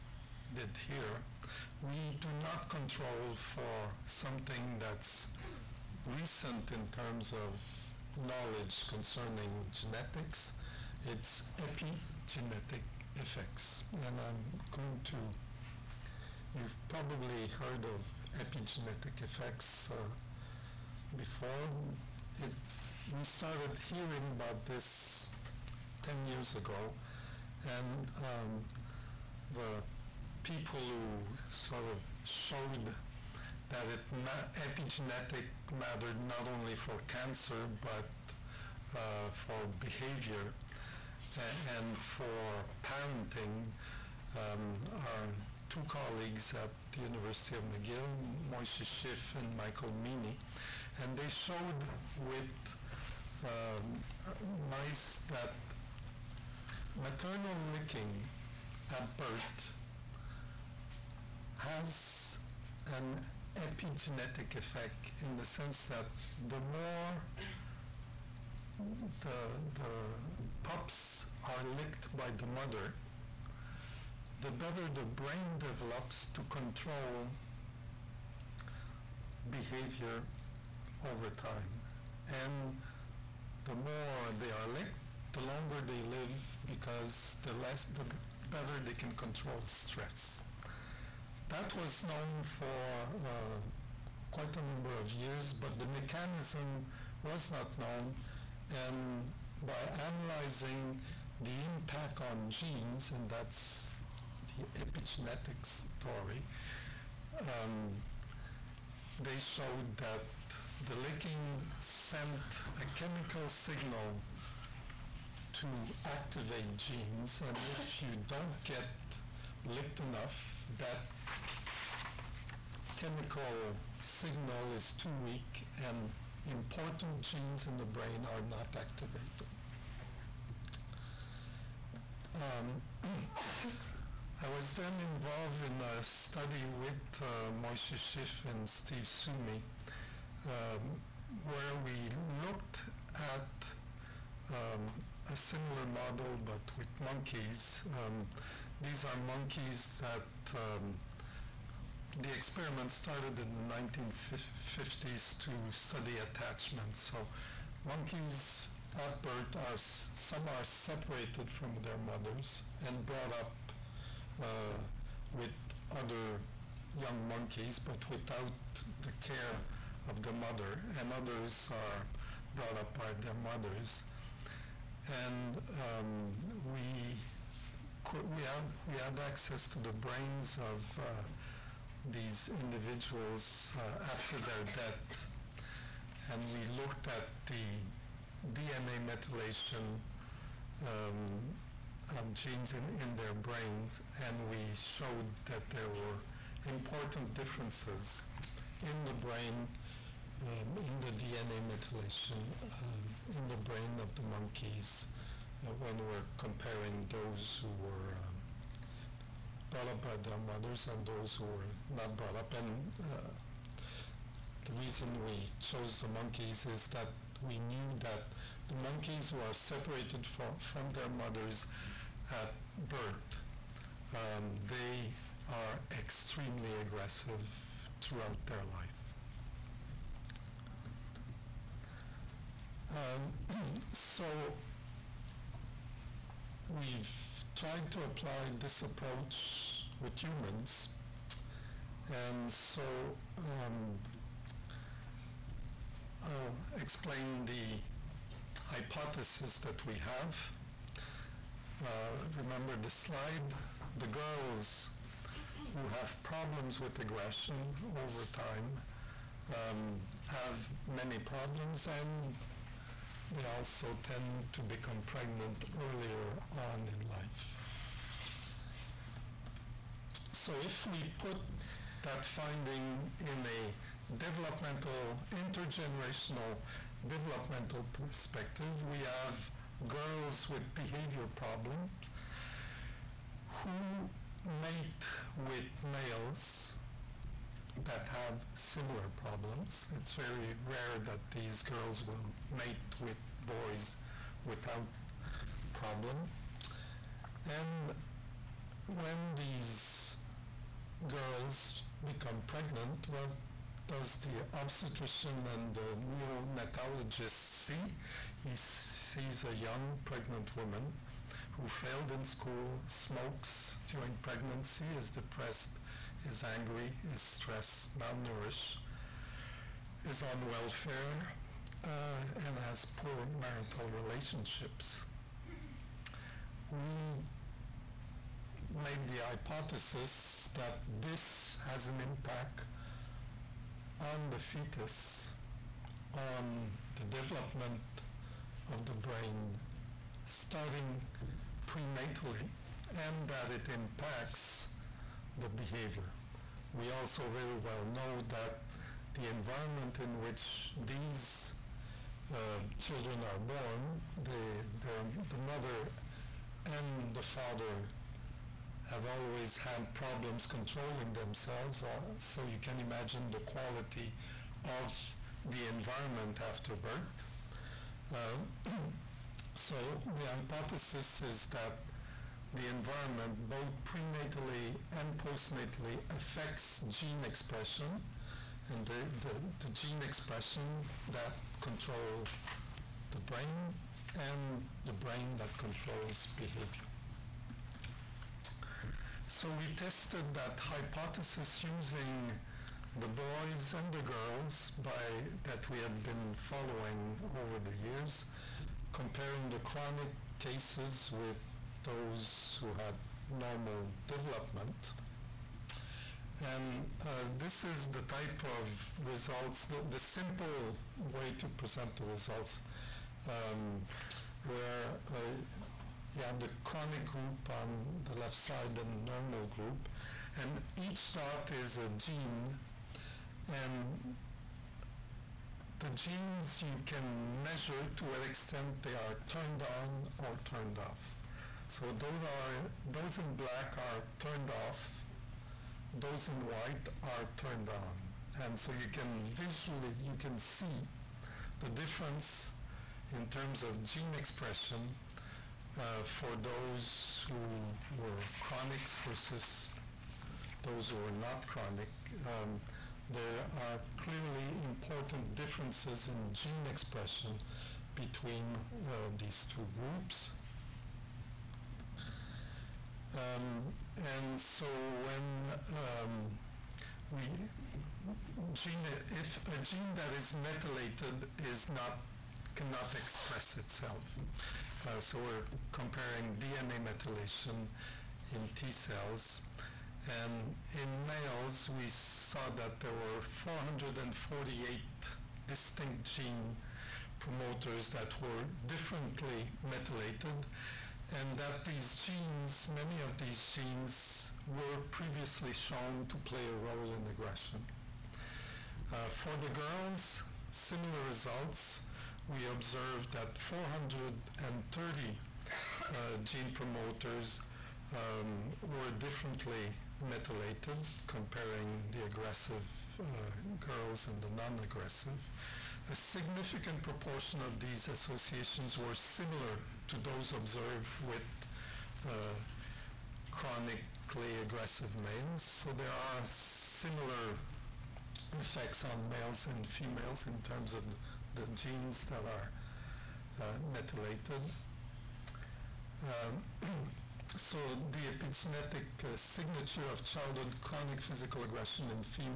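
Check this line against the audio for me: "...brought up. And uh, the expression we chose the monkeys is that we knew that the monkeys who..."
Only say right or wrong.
wrong.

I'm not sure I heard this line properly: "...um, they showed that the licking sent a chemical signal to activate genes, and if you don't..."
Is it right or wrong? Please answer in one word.
right.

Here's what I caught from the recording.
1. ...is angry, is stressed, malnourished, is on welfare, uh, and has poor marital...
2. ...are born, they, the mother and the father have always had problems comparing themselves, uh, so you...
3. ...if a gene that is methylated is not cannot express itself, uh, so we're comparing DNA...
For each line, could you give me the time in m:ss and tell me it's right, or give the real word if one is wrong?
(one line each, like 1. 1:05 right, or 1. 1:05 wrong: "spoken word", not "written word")
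1. 5:16 right
2. 5:53 wrong: "controlling", not "comparing"
3. 7:49 right.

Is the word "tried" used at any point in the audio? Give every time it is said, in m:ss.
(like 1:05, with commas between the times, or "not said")
3:57.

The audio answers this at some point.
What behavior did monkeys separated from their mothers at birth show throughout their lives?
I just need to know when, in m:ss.
3:45.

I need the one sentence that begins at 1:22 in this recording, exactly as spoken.
And the more they are licked, the longer they live because the less the better they can control stress.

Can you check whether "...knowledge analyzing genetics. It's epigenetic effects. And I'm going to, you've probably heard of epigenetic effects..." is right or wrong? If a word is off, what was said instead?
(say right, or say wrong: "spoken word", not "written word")
wrong: "concerning", not "analyzing".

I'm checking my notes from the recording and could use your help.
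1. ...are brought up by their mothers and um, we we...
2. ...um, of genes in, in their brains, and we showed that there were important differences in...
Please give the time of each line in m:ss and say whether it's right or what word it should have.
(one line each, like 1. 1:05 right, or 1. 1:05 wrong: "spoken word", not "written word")
1. 2:51 right
2. 3:10 right.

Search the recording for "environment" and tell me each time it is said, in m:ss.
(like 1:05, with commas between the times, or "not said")
5:49, 6:05, 6:12.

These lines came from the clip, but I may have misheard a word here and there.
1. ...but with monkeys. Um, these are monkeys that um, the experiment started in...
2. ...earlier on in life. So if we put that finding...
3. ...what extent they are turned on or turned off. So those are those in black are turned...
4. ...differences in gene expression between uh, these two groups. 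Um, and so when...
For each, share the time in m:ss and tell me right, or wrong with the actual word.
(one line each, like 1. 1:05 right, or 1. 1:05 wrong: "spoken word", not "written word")
1. 2:26 right
2. 4:25 right
3. 7:08 right
4. 7:35 right.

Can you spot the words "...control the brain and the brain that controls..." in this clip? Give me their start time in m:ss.
6:21.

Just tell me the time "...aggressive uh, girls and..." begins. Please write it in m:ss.
8:32.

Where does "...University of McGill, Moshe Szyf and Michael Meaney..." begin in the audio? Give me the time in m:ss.
0:47.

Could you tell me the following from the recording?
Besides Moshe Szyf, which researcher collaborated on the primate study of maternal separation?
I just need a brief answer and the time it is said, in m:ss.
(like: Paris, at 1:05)
Steve Suomi, at 2:18.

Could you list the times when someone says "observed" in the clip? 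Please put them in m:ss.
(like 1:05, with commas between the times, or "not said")
8:22, 8:40.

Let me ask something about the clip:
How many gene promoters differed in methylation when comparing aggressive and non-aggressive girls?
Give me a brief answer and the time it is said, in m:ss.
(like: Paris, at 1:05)
430, at 8:23.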